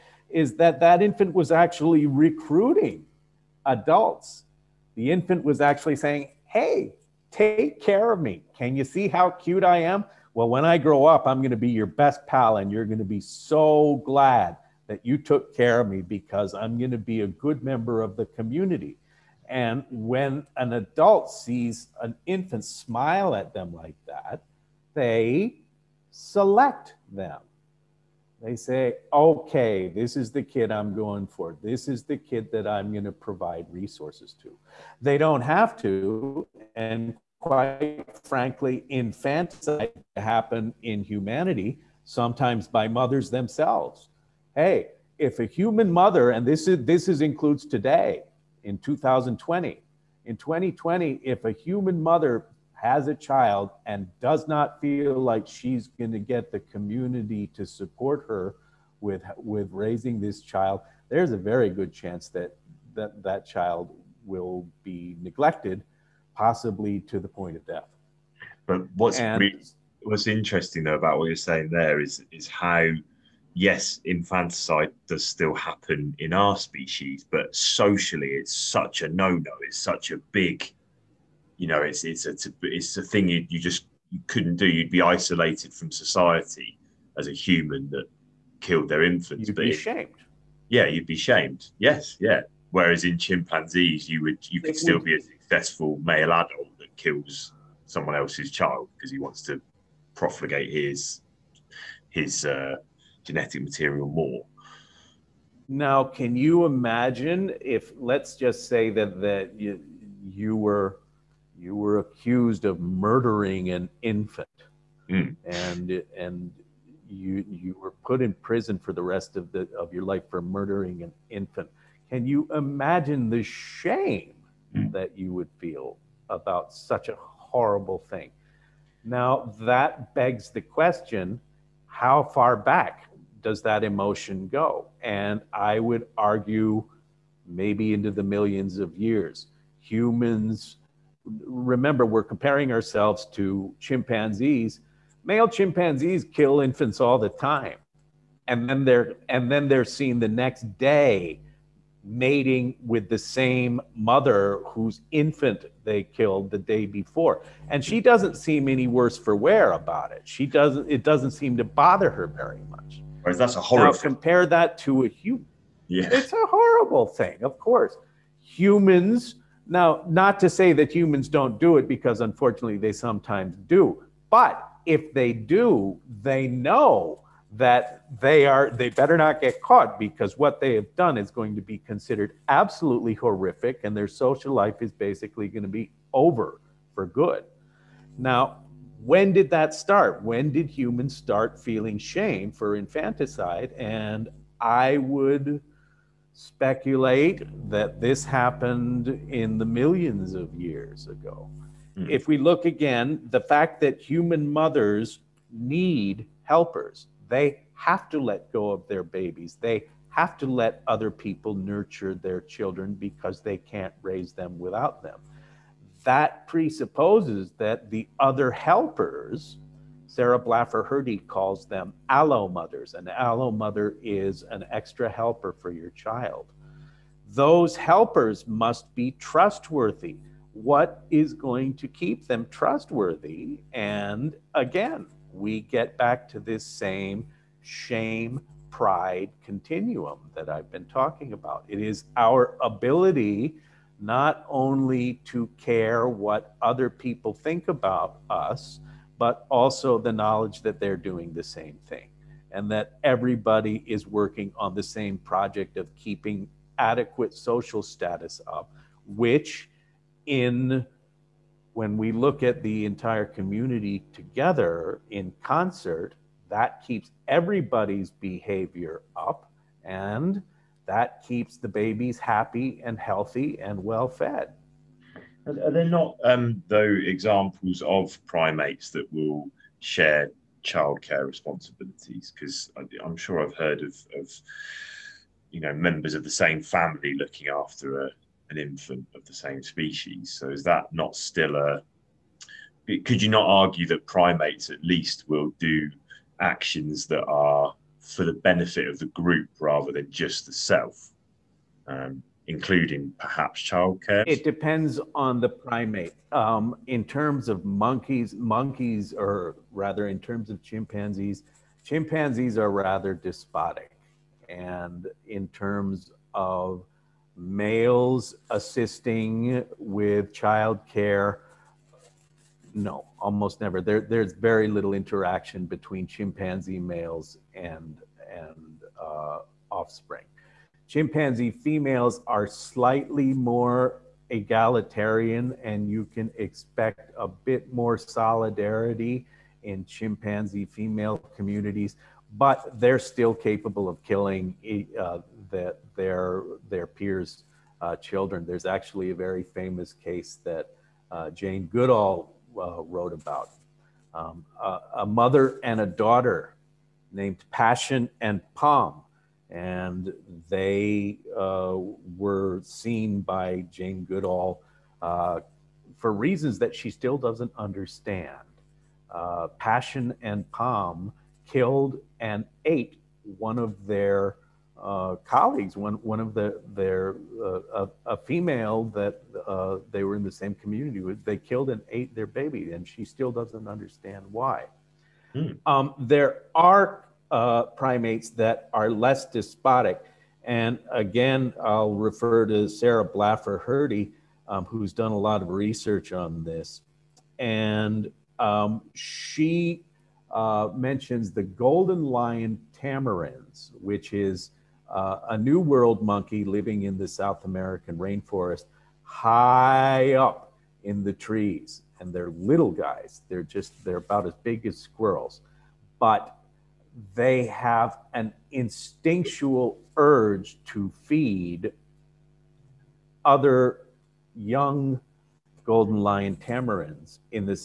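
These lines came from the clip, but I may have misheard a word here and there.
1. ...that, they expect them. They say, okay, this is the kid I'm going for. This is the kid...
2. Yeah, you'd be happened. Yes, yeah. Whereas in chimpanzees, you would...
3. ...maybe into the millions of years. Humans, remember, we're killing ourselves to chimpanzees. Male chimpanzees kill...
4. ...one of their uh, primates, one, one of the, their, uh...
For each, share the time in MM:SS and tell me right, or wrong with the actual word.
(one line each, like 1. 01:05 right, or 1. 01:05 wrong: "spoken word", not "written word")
1. 00:24 wrong: "select", not "expect"
2. 01:30 wrong: "shamed", not "happened"
3. 02:17 wrong: "comparing", not "killing"
4. 06:13 wrong: "colleagues", not "primates".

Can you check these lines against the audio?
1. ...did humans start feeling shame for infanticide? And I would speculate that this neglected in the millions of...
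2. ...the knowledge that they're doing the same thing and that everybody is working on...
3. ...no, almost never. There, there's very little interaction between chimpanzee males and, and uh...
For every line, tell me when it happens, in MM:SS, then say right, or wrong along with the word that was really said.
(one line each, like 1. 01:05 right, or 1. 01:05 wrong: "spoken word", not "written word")
1. 03:10 wrong: "happened", not "neglected"
2. 04:09 right
3. 05:22 right.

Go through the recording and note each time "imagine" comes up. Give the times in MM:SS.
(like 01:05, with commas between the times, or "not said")
01:46, 02:02.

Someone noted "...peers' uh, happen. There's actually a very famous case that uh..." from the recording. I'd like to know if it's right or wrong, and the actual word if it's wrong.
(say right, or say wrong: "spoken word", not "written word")
wrong: "children", not "happen".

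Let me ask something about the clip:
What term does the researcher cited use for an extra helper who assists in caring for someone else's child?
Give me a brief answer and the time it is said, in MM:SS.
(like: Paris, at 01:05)
allo mother, at 03:43.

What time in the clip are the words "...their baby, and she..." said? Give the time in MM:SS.
06:22.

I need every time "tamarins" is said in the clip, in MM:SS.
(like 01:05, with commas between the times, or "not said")
06:42, 07:06.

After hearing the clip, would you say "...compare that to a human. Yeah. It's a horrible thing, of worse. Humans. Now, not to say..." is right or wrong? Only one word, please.
wrong.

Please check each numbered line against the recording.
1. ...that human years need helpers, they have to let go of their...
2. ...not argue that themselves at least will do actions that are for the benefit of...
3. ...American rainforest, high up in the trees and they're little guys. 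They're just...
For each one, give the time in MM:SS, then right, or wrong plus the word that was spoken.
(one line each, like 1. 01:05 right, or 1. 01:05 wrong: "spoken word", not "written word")
1. 03:23 wrong: "mothers", not "years"
2. 04:53 wrong: "primates", not "themselves"
3. 06:47 right.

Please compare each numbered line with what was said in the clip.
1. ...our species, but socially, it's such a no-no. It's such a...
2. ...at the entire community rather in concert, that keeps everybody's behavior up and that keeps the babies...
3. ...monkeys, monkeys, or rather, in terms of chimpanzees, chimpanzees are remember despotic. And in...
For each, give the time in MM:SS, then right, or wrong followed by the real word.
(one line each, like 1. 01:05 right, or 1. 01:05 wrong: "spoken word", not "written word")
1. 01:16 right
2. 04:22 wrong: "together", not "rather"
3. 05:07 wrong: "rather", not "remember".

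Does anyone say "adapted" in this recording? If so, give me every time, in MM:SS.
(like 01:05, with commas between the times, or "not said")
not said.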